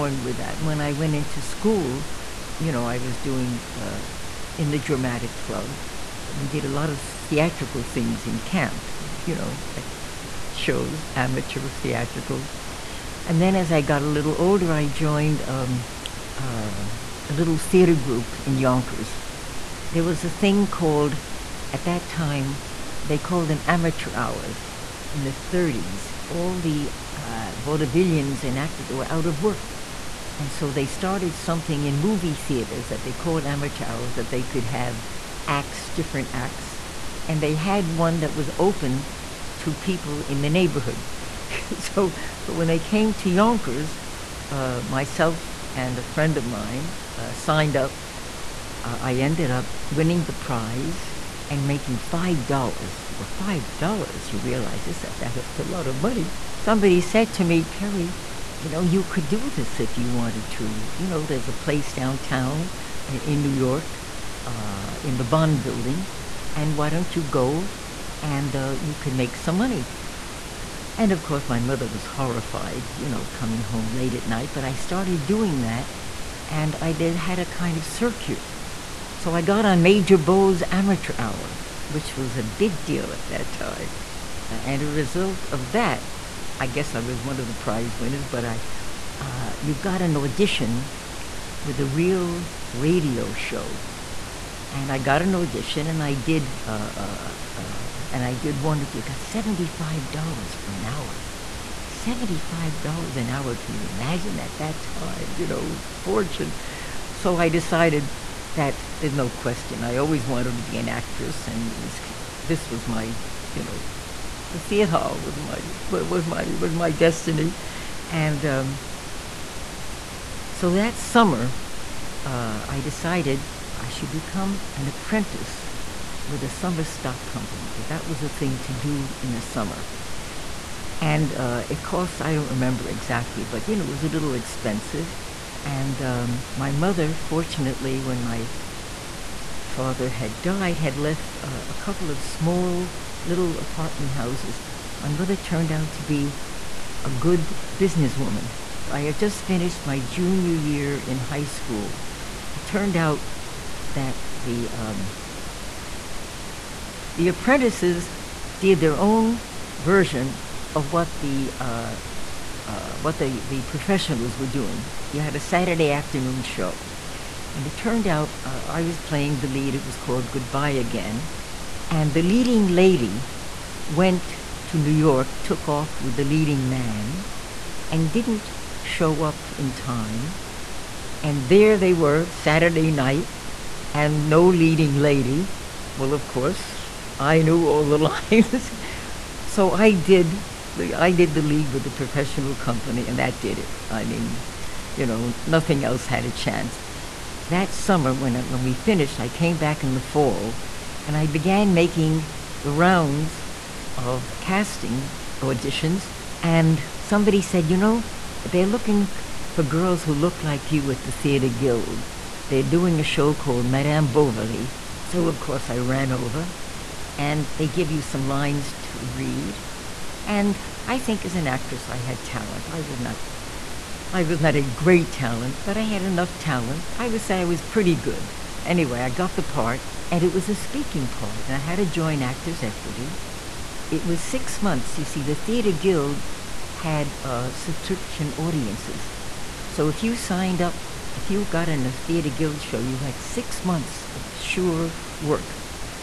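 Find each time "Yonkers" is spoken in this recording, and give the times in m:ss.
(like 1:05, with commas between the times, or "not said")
0:18, 0:43.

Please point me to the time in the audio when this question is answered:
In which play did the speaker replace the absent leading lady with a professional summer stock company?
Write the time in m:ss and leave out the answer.
2:50.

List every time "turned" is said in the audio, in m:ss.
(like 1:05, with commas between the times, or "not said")
2:25, 2:32, 2:47.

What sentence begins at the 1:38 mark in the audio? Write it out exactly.
You got seventy-five dollars for an hour.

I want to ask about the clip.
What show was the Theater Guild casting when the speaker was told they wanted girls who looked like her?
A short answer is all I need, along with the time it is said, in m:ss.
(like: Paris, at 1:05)
Madame Bovary, at 3:33.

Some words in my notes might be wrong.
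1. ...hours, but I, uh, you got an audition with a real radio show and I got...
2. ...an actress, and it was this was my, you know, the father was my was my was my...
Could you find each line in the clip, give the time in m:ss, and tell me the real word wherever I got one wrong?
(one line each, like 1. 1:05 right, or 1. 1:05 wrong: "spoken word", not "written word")
1. 1:27 wrong: "winners", not "hours"
2. 1:50 wrong: "theater", not "father".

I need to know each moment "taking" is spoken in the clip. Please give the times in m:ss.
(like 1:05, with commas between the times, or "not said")
not said.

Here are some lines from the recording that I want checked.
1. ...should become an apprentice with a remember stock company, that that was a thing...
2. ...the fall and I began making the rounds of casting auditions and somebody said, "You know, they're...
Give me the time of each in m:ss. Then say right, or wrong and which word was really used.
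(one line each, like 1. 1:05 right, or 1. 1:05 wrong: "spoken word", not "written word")
1. 2:03 wrong: "summer", not "remember"
2. 3:19 right.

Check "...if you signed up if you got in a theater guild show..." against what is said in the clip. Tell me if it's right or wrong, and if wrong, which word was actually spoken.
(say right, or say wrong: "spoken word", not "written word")
right.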